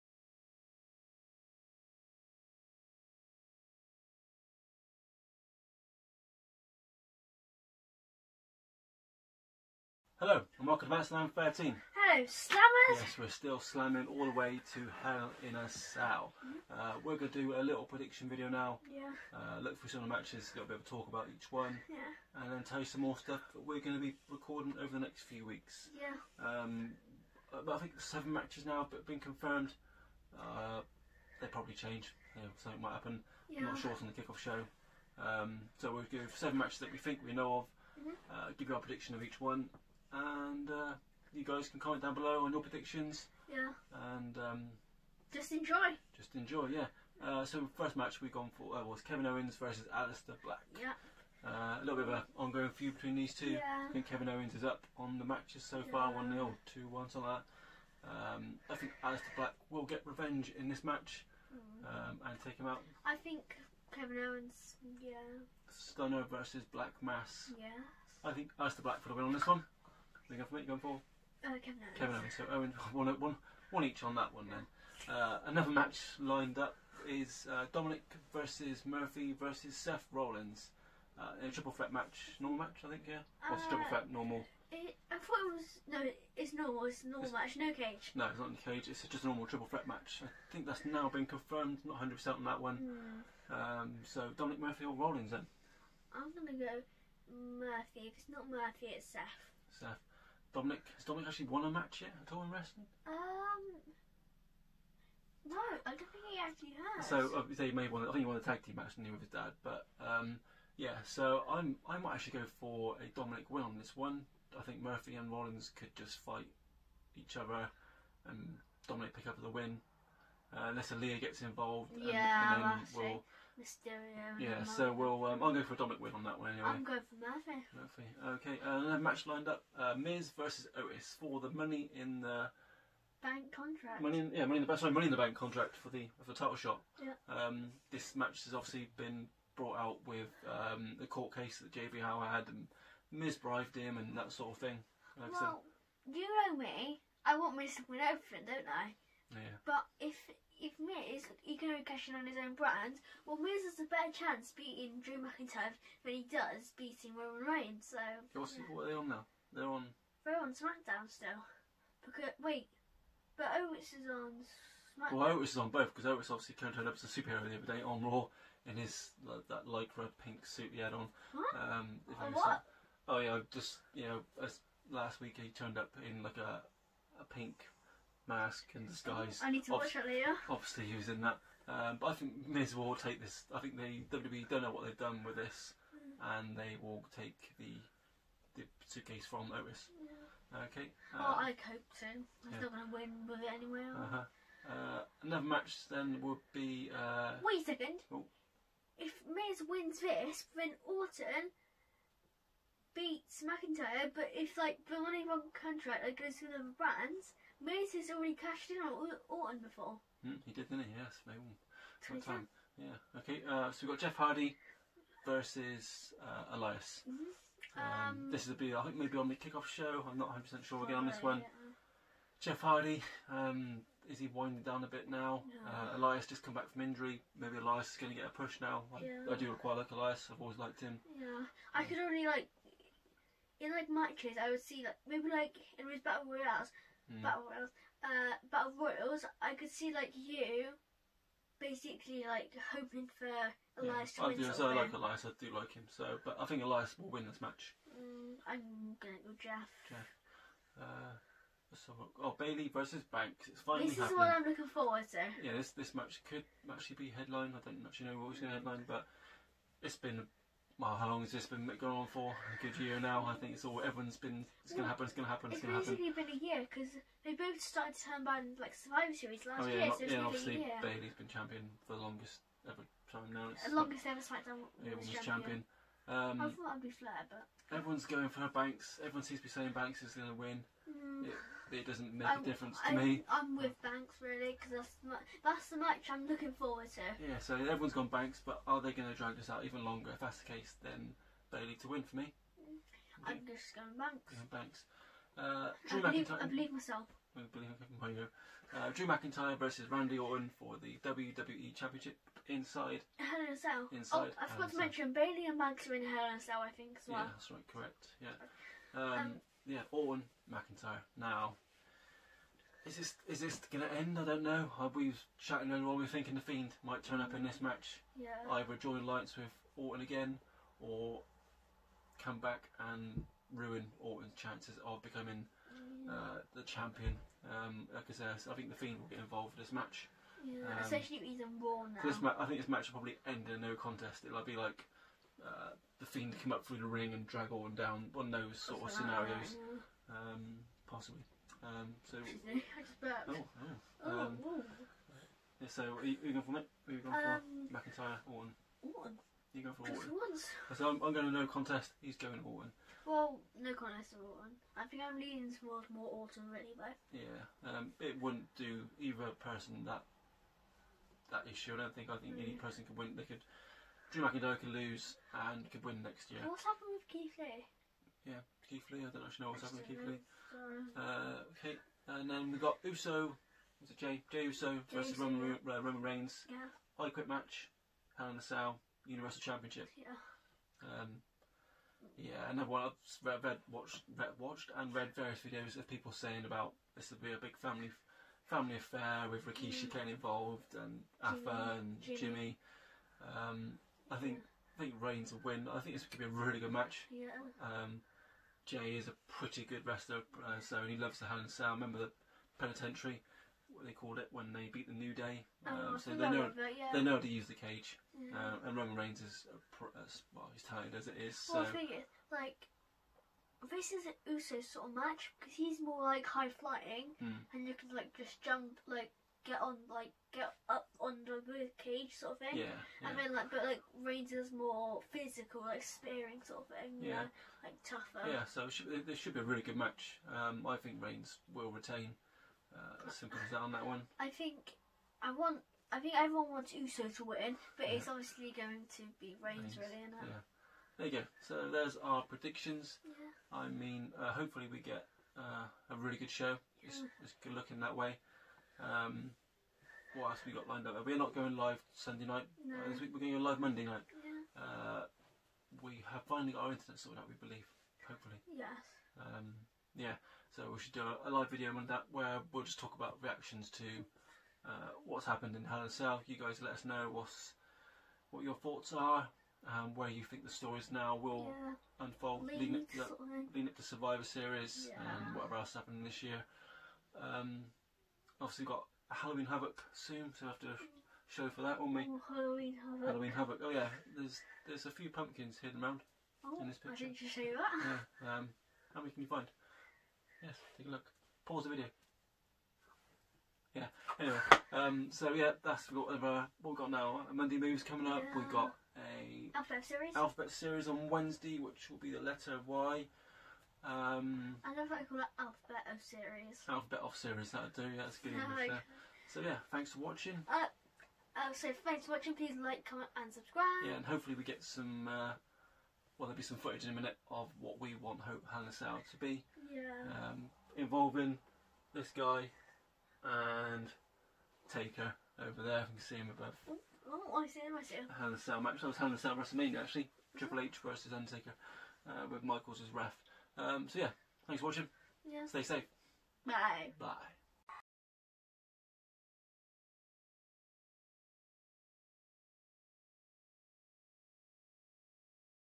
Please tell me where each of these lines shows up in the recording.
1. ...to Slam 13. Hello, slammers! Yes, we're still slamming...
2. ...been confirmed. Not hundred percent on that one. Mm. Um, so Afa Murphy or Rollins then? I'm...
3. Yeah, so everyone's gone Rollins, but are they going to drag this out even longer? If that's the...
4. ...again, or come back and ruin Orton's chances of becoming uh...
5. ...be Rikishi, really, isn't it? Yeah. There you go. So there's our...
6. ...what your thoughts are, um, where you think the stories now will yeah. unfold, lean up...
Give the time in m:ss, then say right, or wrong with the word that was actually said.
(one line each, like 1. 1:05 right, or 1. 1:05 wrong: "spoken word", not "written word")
1. 0:10 right
2. 1:31 wrong: "Dominic", not "Afa"
3. 4:47 wrong: "Banks", not "Rollins"
4. 5:20 right
5. 7:19 wrong: "Reigns", not "Rikishi"
6. 7:48 right.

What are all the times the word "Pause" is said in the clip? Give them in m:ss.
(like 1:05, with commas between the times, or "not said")
8:11.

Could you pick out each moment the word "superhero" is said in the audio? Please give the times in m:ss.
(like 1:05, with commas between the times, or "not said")
2:47.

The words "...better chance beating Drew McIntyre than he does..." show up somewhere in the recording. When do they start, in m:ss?
2:33.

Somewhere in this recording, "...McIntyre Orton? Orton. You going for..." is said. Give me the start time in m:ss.
5:47.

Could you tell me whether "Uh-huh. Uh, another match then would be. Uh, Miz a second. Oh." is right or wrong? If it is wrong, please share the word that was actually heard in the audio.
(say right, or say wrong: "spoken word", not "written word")
wrong: "Wait", not "Miz".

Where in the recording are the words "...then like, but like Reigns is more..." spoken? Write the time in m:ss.
7:03.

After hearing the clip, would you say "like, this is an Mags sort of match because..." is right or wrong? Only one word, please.
wrong.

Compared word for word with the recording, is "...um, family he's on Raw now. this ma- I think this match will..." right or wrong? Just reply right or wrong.
wrong.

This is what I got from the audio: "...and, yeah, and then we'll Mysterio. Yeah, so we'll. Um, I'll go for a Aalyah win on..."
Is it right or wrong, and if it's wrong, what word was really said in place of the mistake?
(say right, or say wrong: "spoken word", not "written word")
wrong: "Dominic", not "Aalyah".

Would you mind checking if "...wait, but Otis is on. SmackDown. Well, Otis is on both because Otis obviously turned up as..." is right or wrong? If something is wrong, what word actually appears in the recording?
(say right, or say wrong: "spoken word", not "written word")
right.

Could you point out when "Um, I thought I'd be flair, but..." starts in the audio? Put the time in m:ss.
4:36.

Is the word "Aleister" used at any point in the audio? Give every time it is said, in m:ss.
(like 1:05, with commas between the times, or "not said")
0:49, 0:59, 1:08.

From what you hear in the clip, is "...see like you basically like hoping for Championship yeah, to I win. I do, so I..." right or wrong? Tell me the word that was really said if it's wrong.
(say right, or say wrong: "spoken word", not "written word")
wrong: "Elias", not "Championship".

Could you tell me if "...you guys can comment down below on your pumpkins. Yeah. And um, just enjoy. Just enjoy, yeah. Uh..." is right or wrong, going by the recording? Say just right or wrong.
wrong.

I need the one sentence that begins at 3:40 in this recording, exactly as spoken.
I'm not 100 percent sure again on this one.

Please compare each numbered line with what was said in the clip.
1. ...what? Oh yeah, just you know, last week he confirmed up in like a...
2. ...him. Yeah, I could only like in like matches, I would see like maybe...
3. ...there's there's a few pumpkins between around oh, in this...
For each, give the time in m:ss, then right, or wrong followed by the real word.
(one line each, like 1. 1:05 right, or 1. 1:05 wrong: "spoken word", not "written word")
1. 2:52 wrong: "turned", not "confirmed"
2. 3:50 right
3. 8:04 wrong: "hidden", not "between".